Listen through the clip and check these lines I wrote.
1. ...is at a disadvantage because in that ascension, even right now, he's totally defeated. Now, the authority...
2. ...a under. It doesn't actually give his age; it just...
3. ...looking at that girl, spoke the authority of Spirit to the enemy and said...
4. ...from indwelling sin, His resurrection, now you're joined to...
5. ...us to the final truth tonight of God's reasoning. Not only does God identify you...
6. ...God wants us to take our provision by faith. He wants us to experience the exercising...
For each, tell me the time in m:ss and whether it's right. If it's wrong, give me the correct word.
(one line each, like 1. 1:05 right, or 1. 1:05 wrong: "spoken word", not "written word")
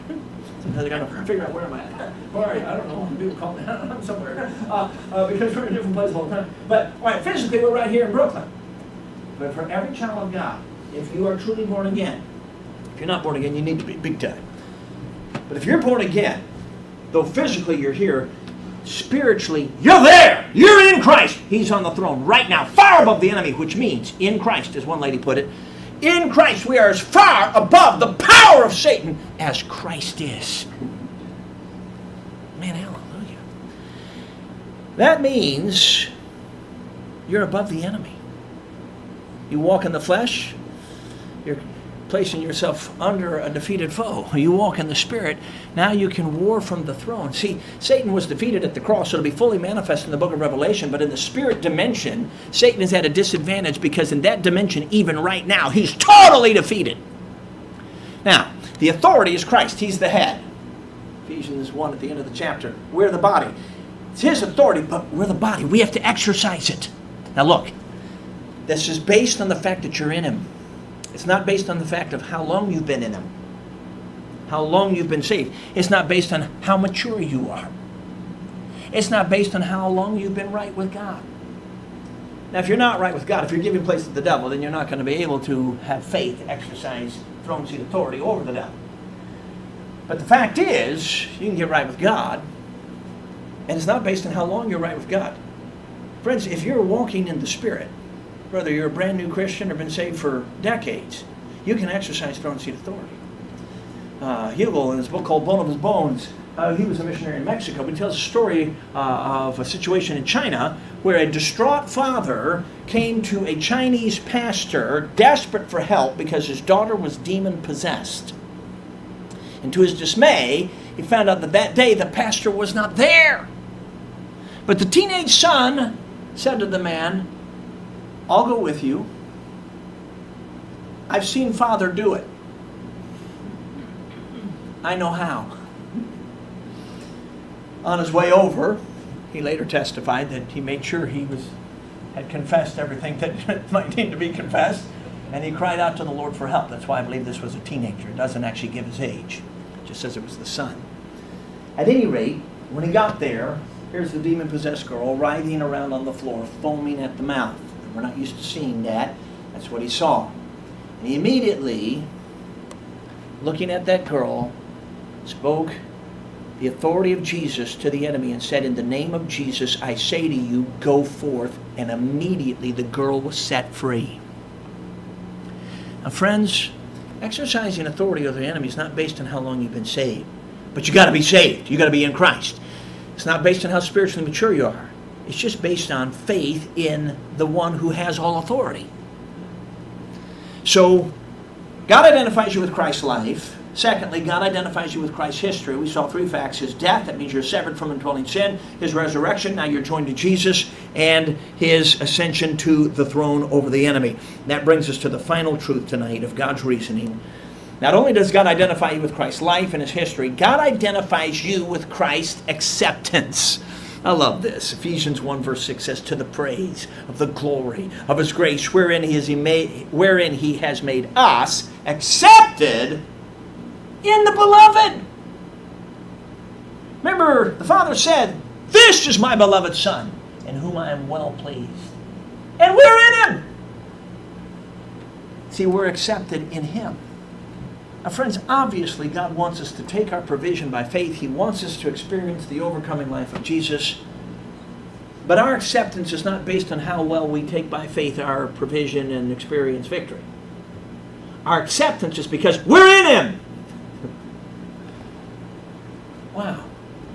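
1. 0:52 wrong: "dimension", not "ascension"
2. 2:27 wrong: "teenager", not "under"
3. 2:43 wrong: "Jesus", not "Spirit"
4. 3:17 right
5. 3:24 right
6. 3:59 wrong: "overcoming", not "exercising".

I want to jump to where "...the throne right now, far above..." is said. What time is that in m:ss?
0:21.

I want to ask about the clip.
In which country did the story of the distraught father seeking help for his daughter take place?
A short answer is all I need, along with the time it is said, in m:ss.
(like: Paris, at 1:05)
China, at 1:50.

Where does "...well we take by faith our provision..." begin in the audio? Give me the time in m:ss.
4:07.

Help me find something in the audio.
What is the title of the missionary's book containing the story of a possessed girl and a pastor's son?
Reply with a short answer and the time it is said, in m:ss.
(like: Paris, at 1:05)
Bone of His Bones, at 1:45.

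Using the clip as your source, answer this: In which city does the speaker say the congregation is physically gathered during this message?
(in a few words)
Brooklyn.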